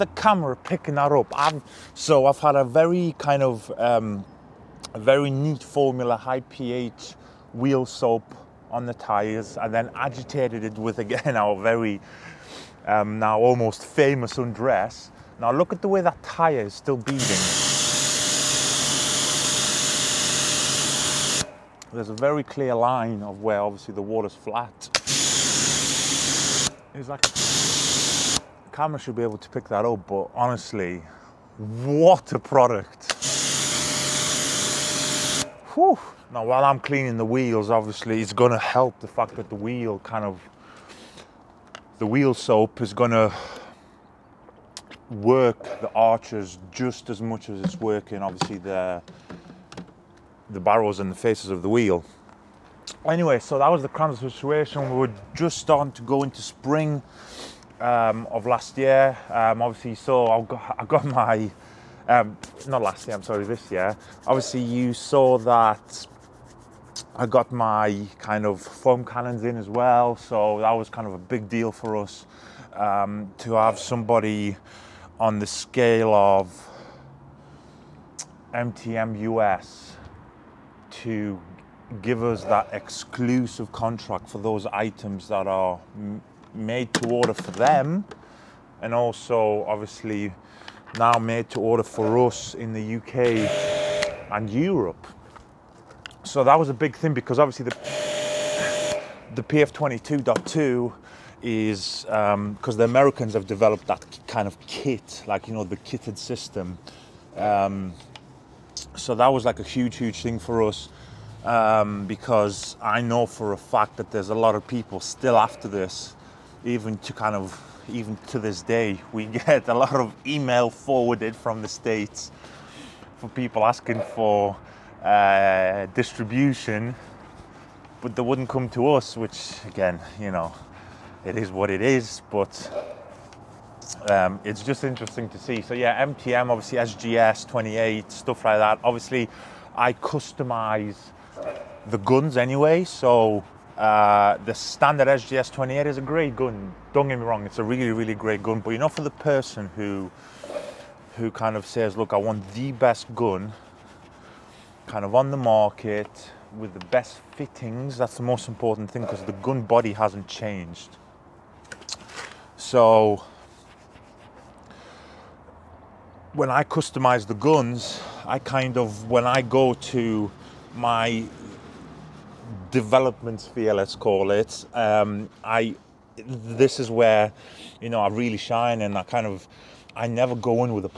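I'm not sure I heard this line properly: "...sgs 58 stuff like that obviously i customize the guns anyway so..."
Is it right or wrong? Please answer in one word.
wrong.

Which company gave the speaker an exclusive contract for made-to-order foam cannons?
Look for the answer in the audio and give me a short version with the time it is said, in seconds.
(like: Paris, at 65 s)
MTM US, at 78 s.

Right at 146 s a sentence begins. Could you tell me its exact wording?
Don't get me wrong, it's a really, really great gun.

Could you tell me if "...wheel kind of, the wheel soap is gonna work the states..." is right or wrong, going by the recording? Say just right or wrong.
wrong.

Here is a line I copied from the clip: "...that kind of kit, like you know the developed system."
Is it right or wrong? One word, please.
wrong.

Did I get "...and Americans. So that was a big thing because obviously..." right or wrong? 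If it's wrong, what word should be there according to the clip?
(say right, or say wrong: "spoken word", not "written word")
wrong: "Europe", not "Americans".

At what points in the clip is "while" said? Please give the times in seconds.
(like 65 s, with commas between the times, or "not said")
36 s.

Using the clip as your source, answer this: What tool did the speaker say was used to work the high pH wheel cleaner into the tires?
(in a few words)
undress.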